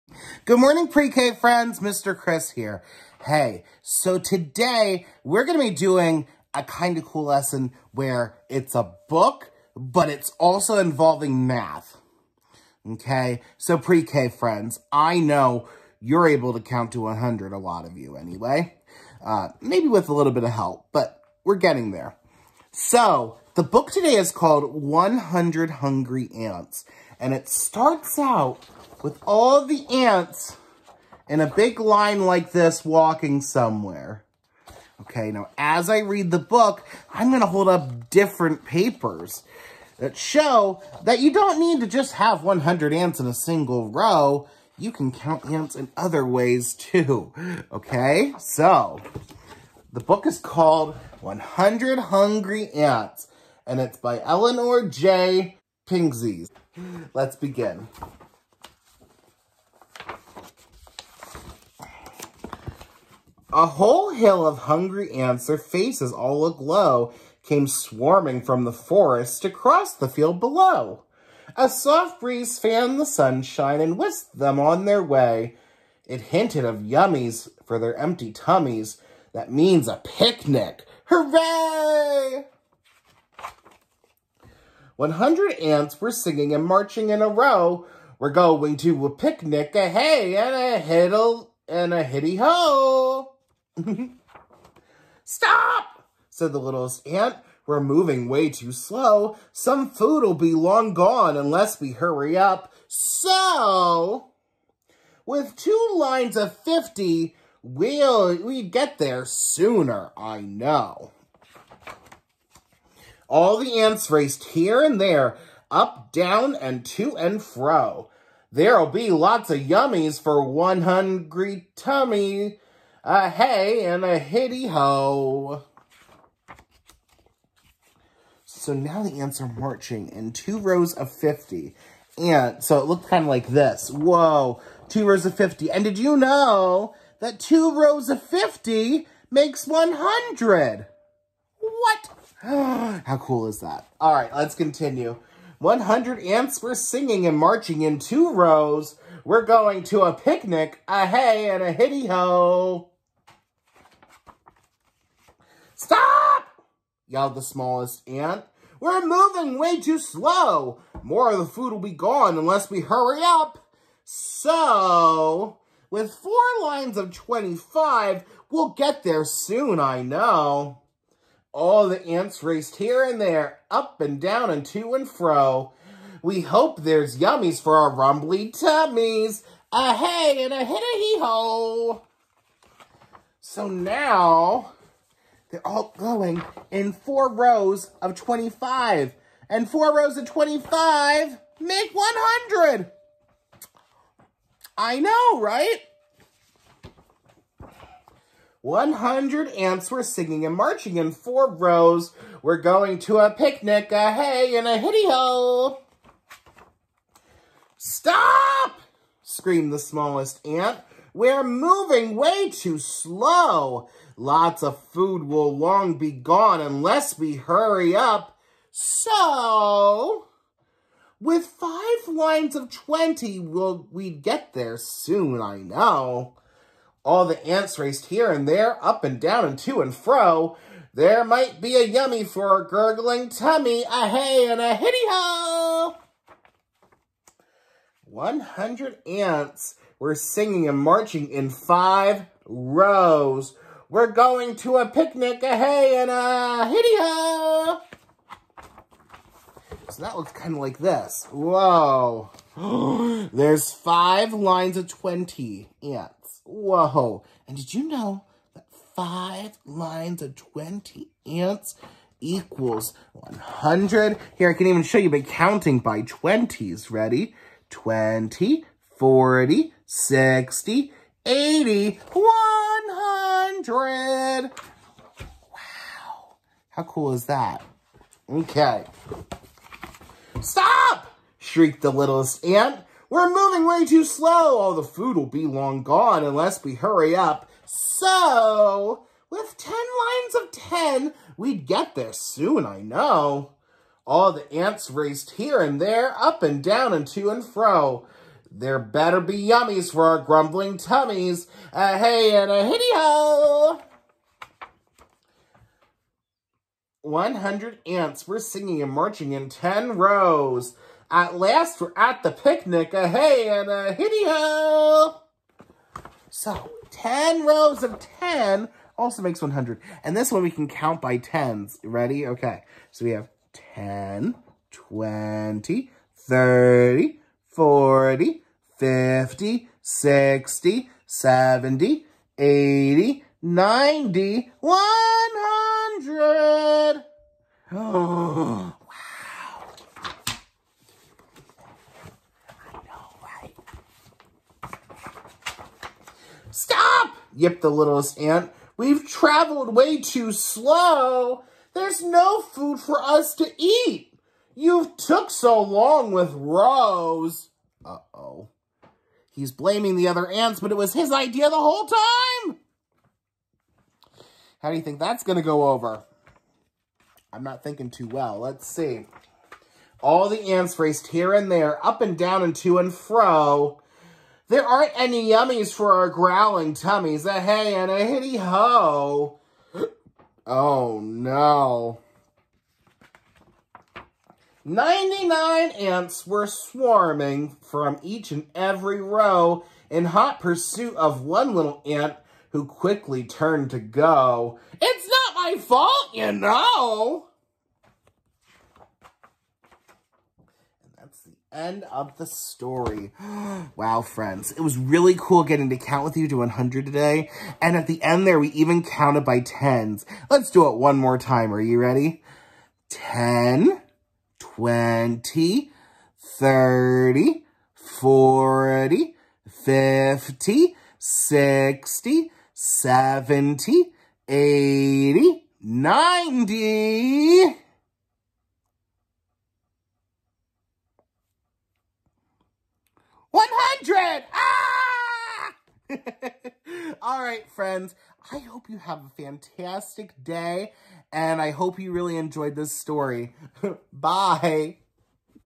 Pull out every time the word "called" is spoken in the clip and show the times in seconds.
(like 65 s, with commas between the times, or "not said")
24 s, 50 s.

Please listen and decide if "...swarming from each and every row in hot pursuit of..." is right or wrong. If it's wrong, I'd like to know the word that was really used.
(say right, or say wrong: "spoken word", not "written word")
right.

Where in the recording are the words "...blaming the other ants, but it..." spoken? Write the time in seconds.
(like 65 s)
359 s.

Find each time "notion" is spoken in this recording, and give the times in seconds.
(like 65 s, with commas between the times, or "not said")
not said.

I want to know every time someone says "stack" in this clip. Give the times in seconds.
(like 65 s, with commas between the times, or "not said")
not said.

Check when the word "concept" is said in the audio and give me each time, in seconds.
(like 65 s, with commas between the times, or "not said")
not said.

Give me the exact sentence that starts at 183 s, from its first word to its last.
So now, they're all going in four rows of 25.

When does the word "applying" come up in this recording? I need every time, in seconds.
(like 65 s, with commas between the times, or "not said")
not said.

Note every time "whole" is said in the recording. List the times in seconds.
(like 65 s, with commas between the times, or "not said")
63 s, 361 s.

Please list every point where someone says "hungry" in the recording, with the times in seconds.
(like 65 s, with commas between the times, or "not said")
25 s, 51 s, 64 s, 120 s.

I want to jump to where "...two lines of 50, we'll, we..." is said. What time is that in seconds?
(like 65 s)
105 s.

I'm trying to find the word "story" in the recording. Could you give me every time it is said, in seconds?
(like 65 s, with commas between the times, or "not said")
402 s, 442 s.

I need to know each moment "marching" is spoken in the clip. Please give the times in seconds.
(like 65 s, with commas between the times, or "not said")
86 s, 129 s, 147 s, 200 s, 240 s, 308 s.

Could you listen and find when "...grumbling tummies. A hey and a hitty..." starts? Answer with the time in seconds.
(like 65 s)
300 s.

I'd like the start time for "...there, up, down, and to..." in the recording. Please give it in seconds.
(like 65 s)
114 s.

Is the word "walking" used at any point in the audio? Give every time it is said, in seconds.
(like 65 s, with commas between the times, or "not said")
32 s.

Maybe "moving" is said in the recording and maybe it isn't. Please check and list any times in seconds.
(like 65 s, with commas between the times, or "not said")
97 s, 159 s, 211 s, 283 s.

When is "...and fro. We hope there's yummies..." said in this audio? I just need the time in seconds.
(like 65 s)
174 s.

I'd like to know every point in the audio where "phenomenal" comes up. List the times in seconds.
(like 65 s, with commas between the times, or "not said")
not said.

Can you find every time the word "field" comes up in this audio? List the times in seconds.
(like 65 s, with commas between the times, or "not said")
70 s.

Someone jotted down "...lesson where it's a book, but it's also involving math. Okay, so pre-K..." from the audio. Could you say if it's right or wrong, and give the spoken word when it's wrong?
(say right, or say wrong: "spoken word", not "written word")
right.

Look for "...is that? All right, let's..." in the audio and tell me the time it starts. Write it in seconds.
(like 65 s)
143 s.